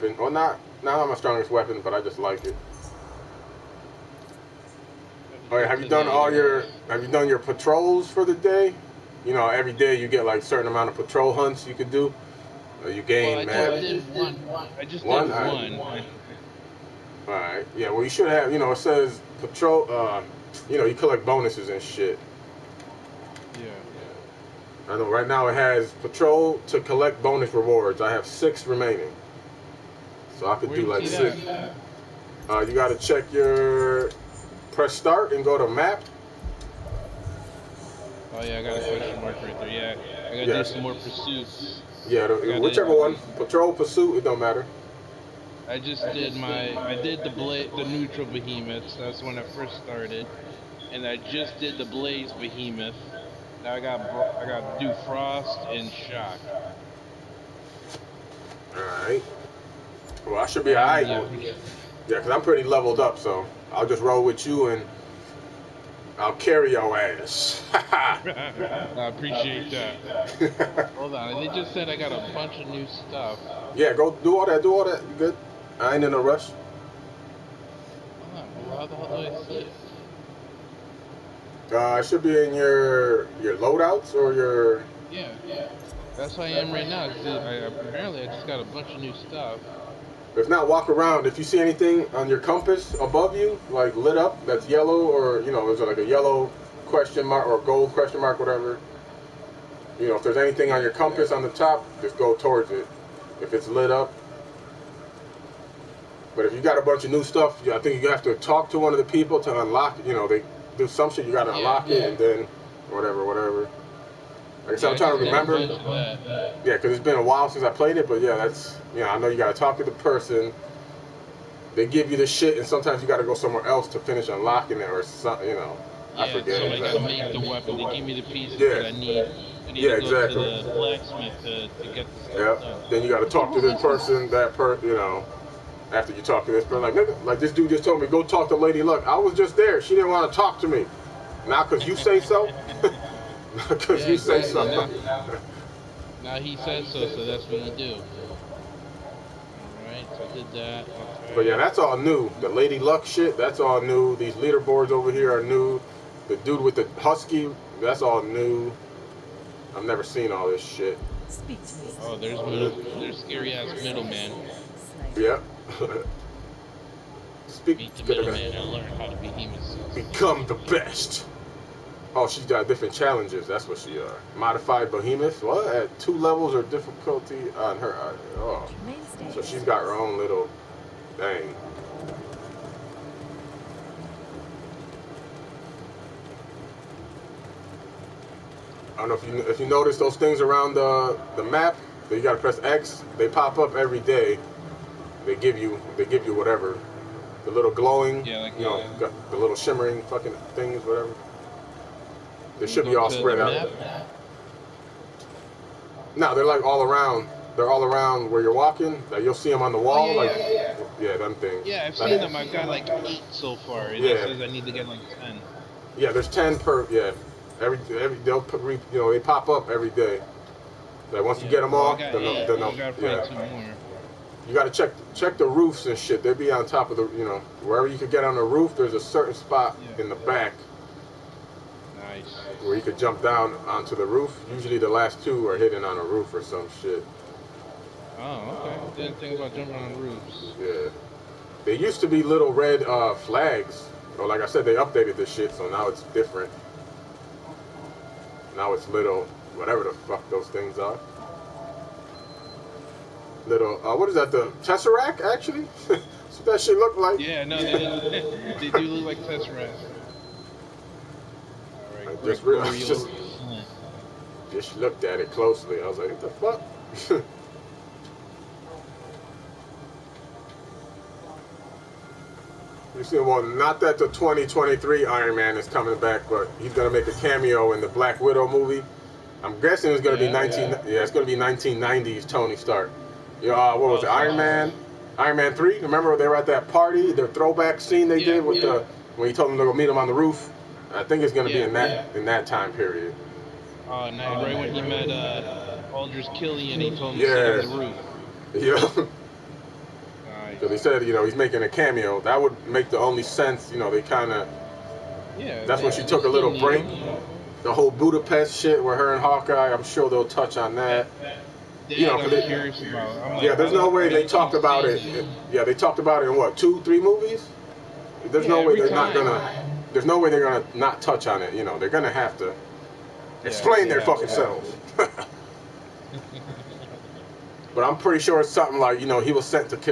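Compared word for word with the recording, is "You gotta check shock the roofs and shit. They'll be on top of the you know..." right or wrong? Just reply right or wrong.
wrong.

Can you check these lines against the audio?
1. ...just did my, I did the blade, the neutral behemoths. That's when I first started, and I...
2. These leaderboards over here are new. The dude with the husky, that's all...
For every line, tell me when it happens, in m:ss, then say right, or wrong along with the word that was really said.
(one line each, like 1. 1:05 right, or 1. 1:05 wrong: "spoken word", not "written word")
1. 0:45 right
2. 2:34 right.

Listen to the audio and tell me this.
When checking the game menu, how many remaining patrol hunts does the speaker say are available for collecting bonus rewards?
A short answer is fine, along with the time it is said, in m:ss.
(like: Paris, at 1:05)
6, at 0:28.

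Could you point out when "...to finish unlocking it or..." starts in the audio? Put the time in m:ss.
2:03.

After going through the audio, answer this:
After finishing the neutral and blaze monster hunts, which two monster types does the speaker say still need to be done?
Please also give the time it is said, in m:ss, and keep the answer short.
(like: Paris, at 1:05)
Frost and shock, at 0:55.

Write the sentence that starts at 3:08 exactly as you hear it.
I don't know if you if you notice those things around the the map that you gotta press X.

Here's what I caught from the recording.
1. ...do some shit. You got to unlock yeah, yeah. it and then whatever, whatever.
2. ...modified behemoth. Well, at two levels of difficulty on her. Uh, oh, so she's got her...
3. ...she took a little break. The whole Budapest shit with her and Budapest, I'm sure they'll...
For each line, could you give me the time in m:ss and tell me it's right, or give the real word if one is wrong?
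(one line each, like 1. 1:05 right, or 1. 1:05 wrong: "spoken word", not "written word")
1. 1:50 right
2. 2:54 right
3. 5:05 wrong: "Hawkeye", not "Budapest".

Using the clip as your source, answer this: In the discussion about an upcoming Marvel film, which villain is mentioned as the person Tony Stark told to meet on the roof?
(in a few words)
Aldrich Killian.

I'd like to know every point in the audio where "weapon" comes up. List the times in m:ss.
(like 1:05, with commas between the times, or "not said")
0:01, 2:07.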